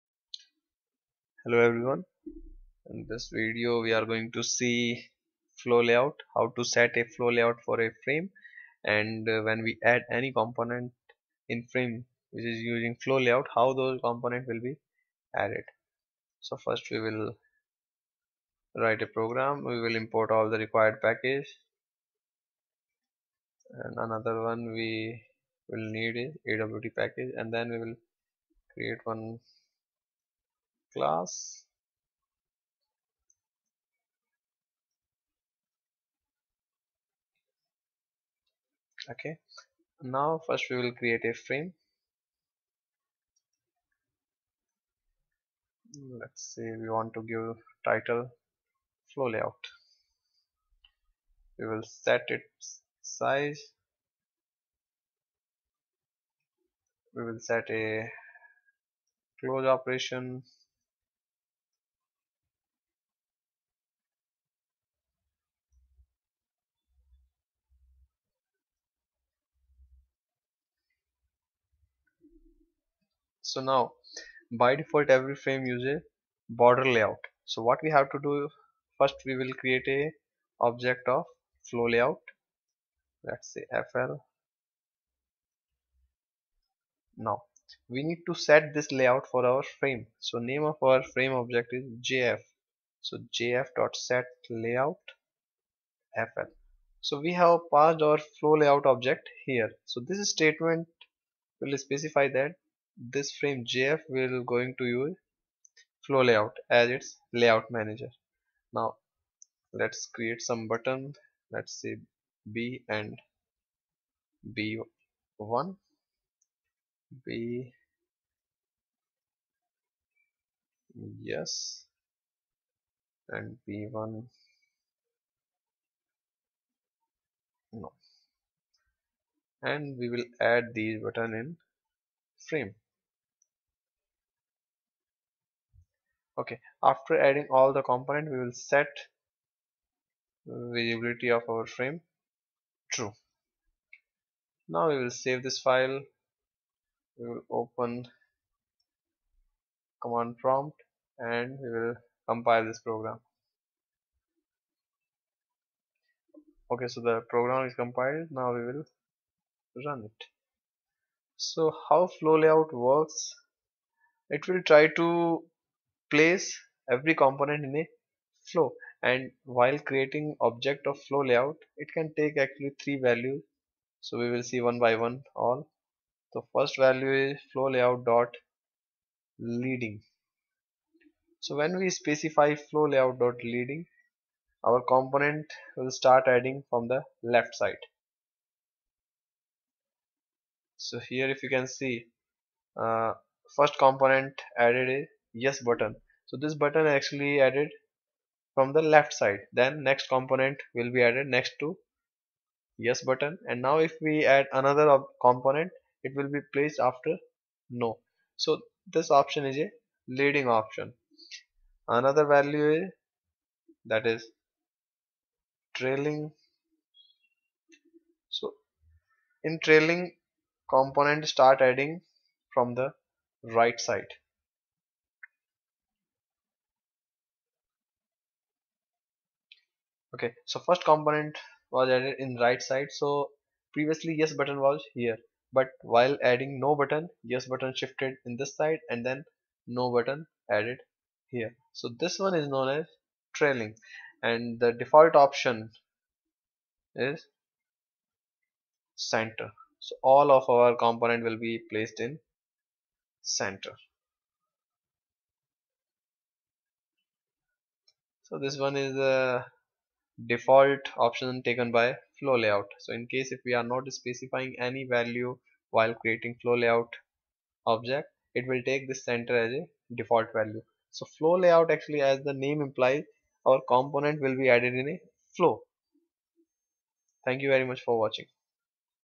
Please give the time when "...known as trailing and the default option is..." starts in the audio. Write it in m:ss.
4:02.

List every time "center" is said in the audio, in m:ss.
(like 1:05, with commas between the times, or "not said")
4:08, 4:13, 4:29.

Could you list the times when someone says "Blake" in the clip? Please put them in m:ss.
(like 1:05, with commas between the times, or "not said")
not said.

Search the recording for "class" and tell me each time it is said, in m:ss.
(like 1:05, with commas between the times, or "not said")
0:30.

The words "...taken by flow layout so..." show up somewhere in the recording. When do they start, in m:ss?
4:21.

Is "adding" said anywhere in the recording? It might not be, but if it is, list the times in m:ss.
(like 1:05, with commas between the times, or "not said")
2:17, 3:06, 3:41, 3:56.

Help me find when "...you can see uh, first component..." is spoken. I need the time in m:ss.
3:11.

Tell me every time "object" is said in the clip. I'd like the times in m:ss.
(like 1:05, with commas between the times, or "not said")
1:20, 1:31, 1:38, 2:50, 4:27.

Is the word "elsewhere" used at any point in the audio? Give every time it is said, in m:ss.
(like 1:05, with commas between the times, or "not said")
not said.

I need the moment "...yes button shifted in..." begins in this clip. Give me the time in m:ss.
3:57.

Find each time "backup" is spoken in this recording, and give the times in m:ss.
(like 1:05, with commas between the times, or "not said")
not said.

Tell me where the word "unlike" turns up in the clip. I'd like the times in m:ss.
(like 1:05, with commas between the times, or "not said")
not said.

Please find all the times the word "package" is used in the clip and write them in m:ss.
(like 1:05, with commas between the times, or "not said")
0:21, 0:26.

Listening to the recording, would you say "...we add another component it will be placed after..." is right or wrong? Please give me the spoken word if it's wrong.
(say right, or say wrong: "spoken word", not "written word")
right.